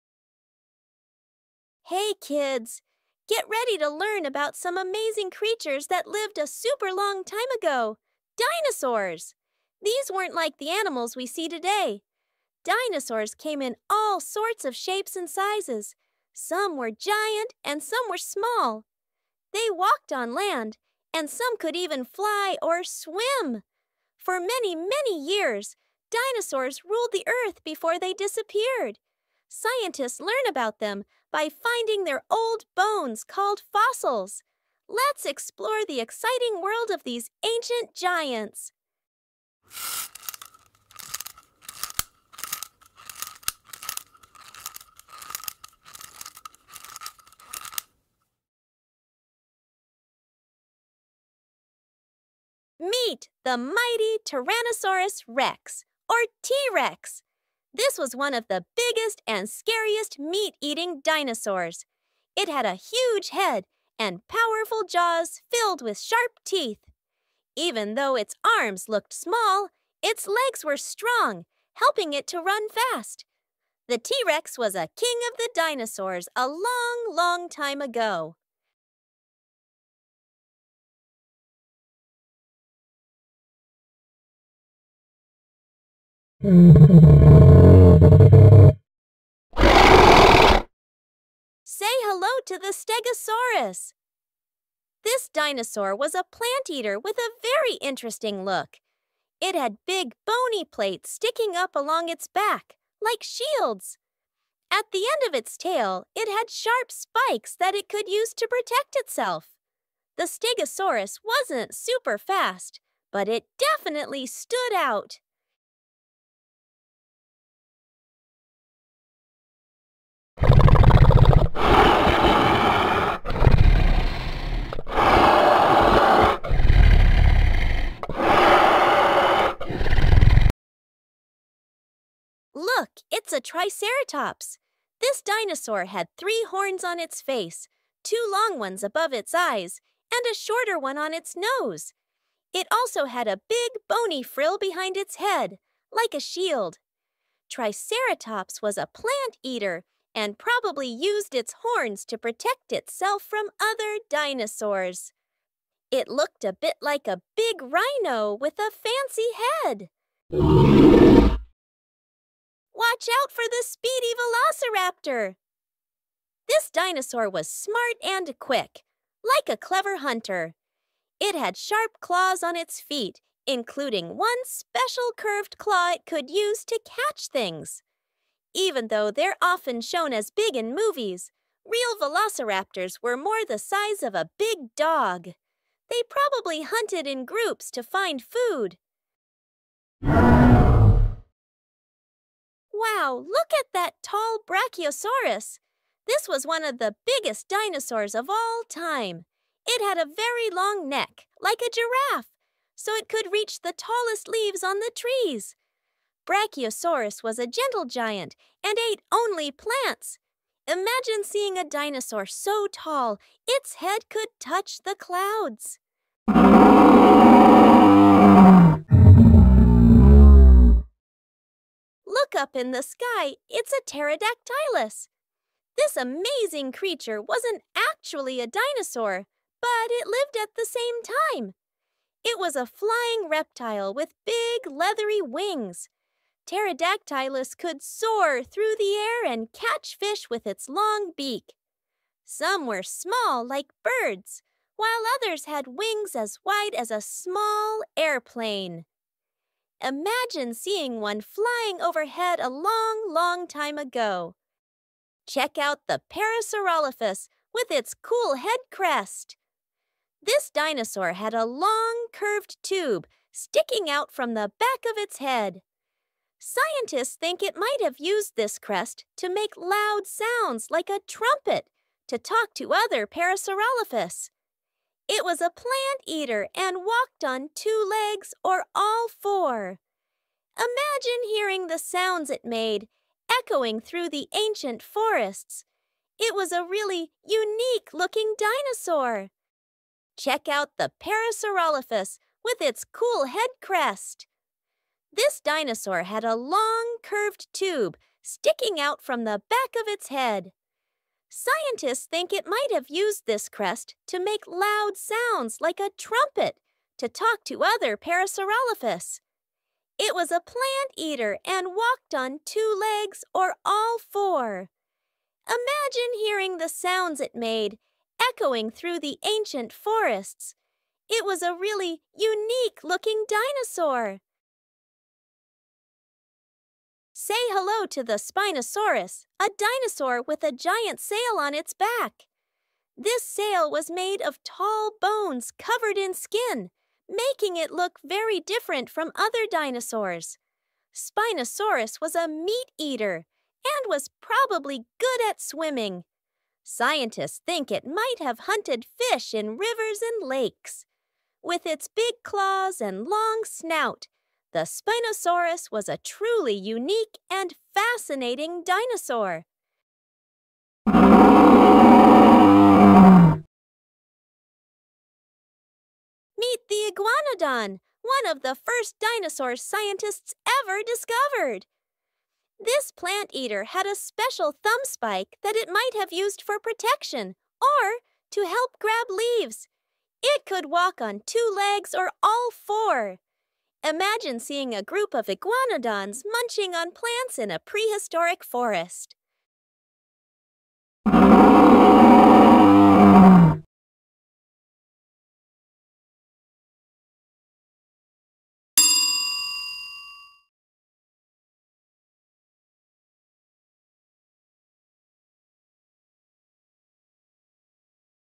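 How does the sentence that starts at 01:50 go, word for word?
The Stegosaurus wasn't super fast, but it definitely stood out.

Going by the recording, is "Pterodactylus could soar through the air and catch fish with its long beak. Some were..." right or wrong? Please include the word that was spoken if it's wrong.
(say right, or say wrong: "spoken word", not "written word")
right.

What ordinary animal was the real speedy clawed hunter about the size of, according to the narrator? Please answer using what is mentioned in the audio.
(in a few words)
a big dog.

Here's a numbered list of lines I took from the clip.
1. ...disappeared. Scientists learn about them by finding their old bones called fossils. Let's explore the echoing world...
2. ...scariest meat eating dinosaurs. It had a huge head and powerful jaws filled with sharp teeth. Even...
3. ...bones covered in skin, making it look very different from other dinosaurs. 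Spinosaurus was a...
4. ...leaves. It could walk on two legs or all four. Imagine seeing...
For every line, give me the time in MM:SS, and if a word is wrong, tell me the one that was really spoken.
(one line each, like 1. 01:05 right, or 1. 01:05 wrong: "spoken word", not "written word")
1. 00:28 wrong: "exciting", not "echoing"
2. 00:59 right
3. 05:34 right
4. 06:19 right.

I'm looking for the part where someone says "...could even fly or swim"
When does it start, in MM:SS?
00:21.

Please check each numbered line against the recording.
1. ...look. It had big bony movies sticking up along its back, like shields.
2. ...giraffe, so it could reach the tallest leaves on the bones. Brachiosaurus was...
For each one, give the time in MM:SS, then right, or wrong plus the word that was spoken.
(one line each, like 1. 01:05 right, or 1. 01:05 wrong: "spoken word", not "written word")
1. 01:38 wrong: "plates", not "movies"
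2. 03:21 wrong: "trees", not "bones".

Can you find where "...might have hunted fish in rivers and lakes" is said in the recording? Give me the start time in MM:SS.
05:47.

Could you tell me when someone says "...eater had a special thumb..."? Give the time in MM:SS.
06:13.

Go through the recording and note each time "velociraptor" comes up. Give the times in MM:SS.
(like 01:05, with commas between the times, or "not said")
02:44, 03:02.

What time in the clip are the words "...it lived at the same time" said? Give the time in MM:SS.
03:49.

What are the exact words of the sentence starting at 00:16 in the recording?
Some were giant and some were small.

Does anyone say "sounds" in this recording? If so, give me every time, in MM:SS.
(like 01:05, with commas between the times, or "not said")
04:30, 04:41, 05:04, 05:16.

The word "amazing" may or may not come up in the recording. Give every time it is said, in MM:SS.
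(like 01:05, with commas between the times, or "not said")
00:04, 03:45.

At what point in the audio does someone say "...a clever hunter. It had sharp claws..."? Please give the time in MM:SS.
02:49.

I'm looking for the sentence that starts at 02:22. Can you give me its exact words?
It also had a big bony frill behind its head, like a shield.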